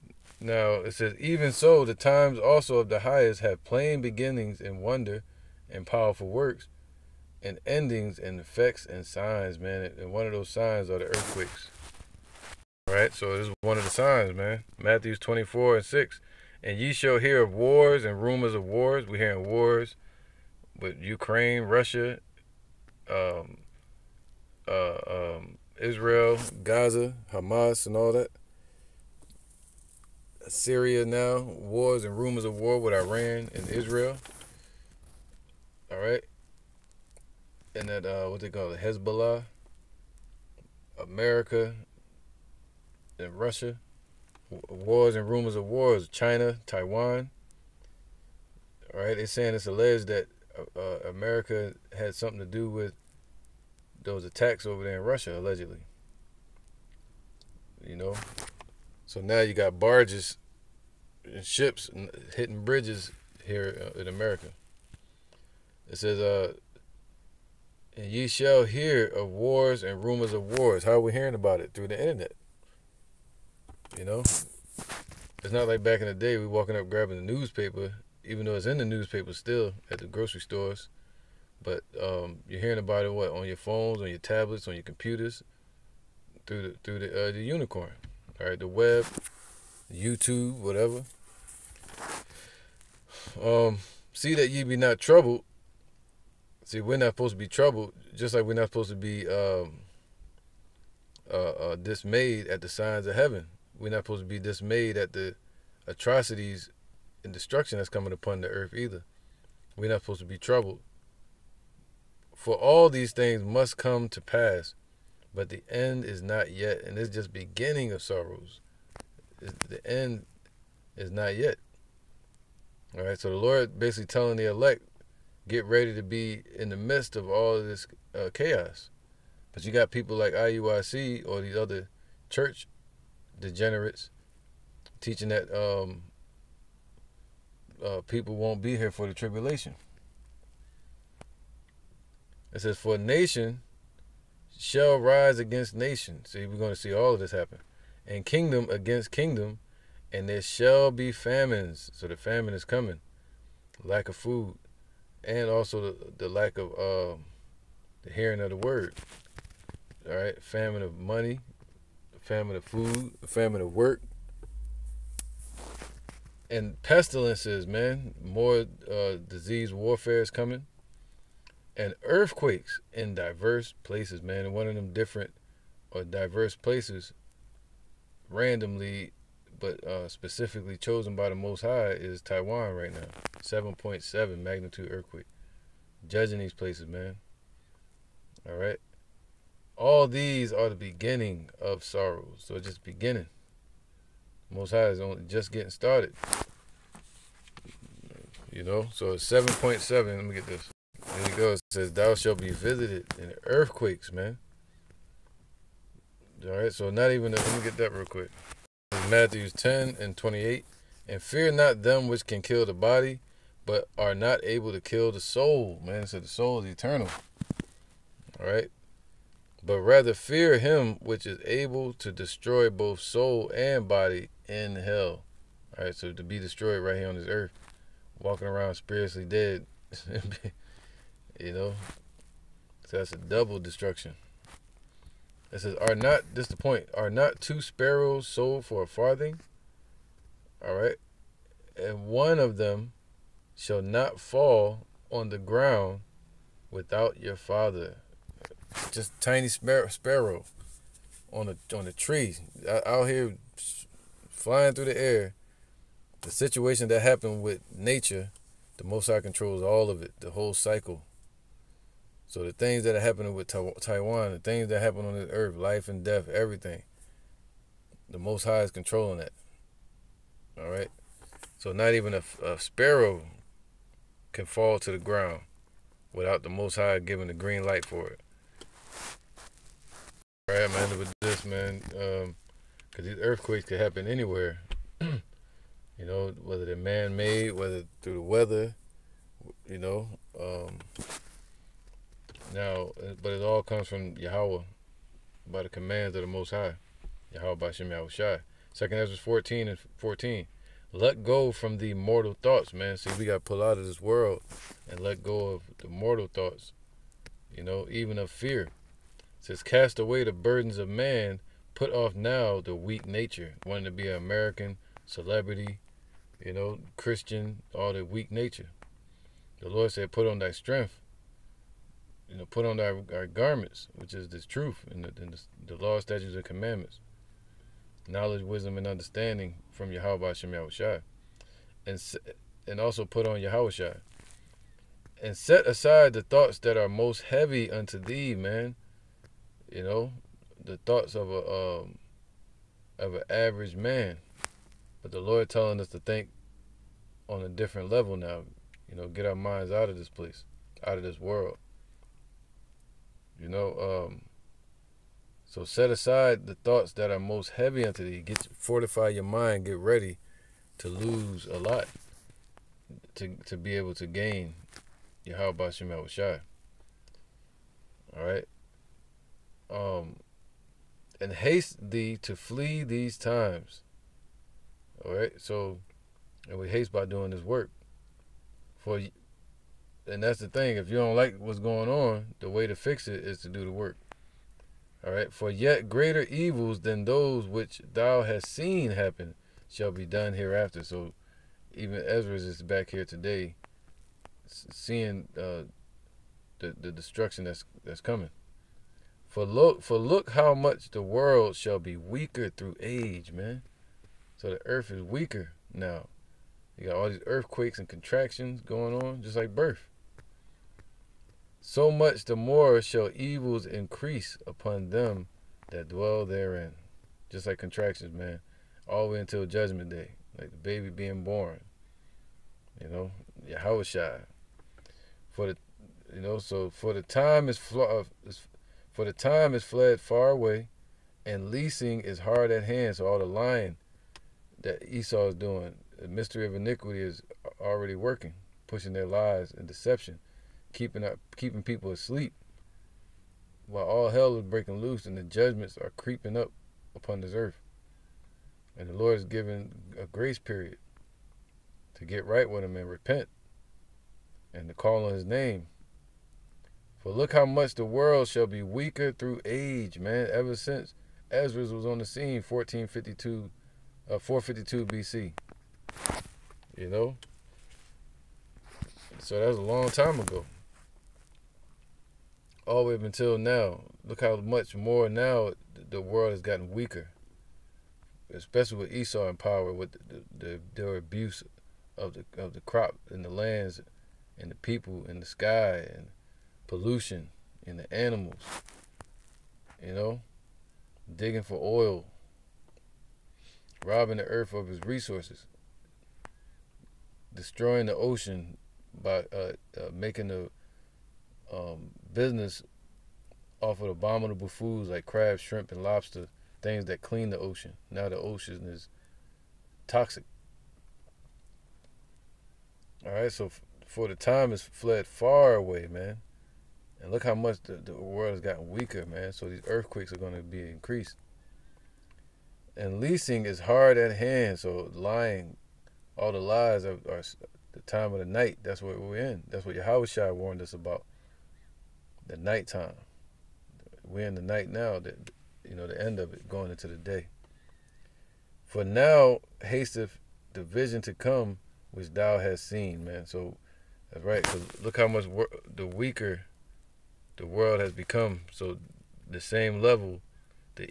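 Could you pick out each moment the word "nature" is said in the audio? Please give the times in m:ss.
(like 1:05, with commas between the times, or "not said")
4:17, 5:13, 5:18.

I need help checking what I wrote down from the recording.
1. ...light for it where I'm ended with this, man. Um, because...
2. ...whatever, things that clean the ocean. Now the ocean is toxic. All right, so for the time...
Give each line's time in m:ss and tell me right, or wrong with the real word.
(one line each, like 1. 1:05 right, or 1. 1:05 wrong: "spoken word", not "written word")
1. 4:37 right
2. 8:25 wrong: "lobster", not "whatever".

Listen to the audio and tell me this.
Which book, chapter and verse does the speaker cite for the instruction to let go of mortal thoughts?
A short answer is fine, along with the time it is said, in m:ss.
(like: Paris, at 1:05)
2 Esdras 14:14, at 4:58.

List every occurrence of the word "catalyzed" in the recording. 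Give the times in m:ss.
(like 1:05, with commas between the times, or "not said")
not said.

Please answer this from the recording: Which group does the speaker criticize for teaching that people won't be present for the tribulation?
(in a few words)
IUIC.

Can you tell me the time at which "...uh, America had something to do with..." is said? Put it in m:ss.
0:50.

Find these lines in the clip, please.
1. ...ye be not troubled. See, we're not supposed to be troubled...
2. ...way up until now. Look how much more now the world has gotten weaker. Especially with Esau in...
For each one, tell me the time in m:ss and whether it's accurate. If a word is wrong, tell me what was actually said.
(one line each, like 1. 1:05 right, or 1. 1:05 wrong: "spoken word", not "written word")
1. 1:34 right
2. 7:52 right.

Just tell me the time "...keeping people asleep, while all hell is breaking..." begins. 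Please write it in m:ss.
7:21.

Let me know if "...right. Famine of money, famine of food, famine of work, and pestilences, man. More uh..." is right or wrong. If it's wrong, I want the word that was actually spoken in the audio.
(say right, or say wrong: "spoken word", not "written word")
right.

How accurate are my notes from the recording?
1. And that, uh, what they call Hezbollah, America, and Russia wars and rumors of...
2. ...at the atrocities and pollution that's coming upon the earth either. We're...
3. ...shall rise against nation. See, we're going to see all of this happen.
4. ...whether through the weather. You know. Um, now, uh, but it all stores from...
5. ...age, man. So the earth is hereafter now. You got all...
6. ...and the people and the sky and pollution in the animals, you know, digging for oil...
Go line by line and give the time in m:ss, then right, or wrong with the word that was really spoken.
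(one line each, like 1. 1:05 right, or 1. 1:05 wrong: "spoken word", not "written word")
1. 0:37 right
2. 1:44 wrong: "destruction", not "pollution"
3. 2:24 right
4. 4:47 wrong: "comes", not "stores"
5. 6:42 wrong: "weaker", not "hereafter"
6. 8:04 right.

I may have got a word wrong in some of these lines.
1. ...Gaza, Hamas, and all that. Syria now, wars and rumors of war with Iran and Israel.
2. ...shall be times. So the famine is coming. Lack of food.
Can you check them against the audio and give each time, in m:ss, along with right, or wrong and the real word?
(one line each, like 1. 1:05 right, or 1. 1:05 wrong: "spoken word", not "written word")
1. 0:26 right
2. 2:30 wrong: "famines", not "times".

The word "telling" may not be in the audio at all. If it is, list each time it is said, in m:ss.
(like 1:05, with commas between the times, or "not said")
2:04, 5:45.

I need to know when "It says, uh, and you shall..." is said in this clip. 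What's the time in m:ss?
1:05.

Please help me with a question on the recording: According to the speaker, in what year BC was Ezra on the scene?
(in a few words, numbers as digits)
452 BC.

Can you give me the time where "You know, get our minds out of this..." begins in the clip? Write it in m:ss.
5:48.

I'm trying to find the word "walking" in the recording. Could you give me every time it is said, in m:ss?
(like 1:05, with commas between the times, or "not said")
1:16, 3:48.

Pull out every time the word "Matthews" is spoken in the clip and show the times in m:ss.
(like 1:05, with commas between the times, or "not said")
0:14, 3:29.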